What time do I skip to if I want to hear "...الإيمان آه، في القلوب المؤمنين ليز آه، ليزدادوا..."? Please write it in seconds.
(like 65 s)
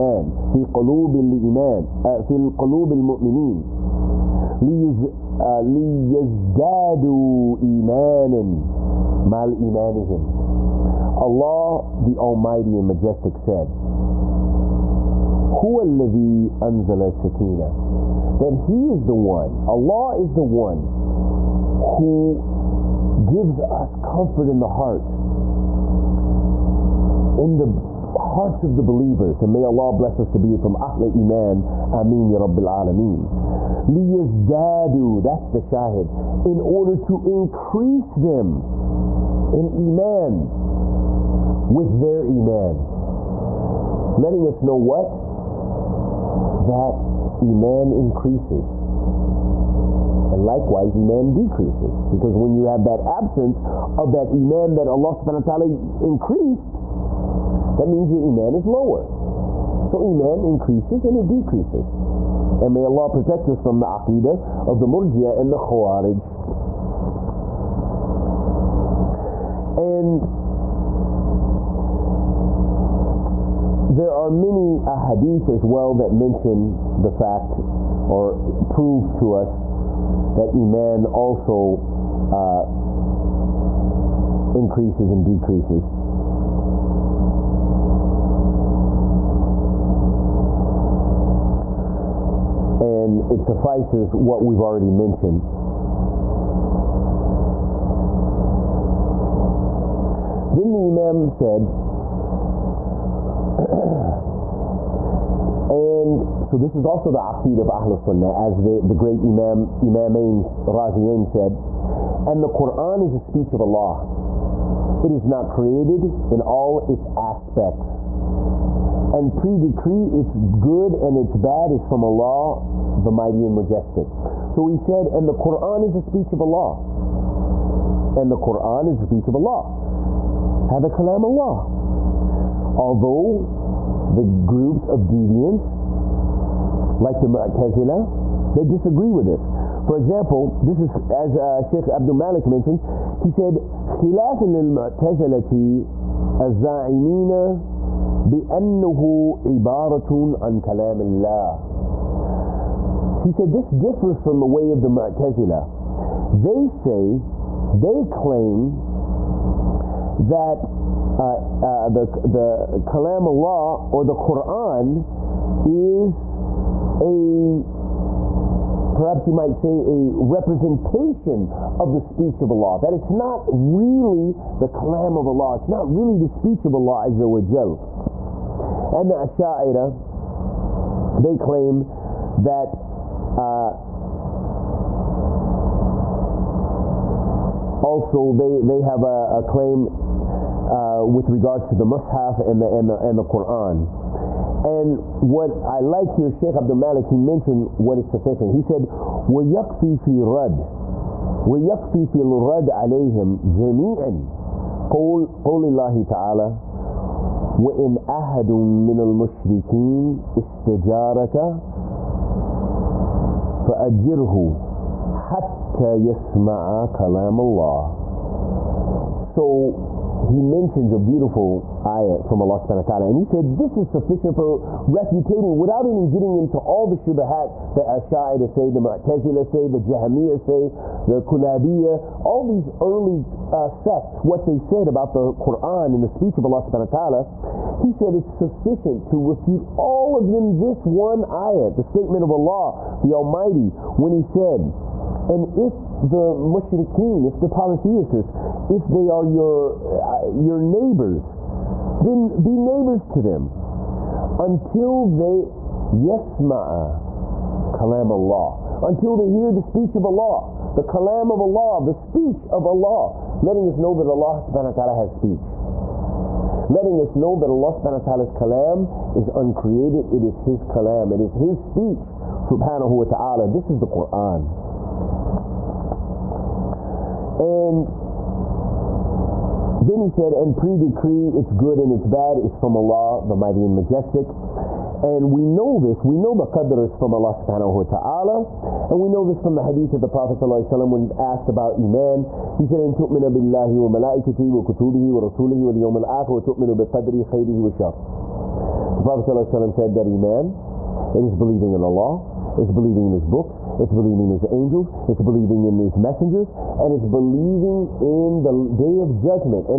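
1 s.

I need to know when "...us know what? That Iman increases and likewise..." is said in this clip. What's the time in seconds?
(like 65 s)
44 s.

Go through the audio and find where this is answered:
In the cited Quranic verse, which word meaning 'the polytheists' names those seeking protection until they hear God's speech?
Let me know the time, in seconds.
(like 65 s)
246 s.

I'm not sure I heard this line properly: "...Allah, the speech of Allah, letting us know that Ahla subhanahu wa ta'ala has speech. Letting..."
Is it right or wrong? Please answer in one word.
wrong.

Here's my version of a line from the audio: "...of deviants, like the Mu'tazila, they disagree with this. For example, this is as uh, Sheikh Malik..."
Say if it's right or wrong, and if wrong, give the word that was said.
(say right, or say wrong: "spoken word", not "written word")
wrong: "Abdul", not "Malik".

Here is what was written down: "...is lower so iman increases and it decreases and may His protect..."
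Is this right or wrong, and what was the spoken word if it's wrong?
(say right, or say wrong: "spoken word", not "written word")
wrong: "Allah", not "His".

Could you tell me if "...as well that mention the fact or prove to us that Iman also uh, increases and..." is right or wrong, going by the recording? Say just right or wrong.
right.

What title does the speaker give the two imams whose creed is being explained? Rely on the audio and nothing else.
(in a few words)
Imamain Raziyain.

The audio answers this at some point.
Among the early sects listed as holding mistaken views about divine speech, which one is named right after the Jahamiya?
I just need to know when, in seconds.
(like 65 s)
231 s.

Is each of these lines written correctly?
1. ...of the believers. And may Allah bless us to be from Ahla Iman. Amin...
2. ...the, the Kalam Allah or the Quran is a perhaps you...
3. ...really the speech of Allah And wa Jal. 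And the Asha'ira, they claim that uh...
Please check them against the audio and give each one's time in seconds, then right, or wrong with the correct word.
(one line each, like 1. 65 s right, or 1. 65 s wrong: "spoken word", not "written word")
1. 28 s right
2. 161 s right
3. 175 s wrong: "Azza", not "And".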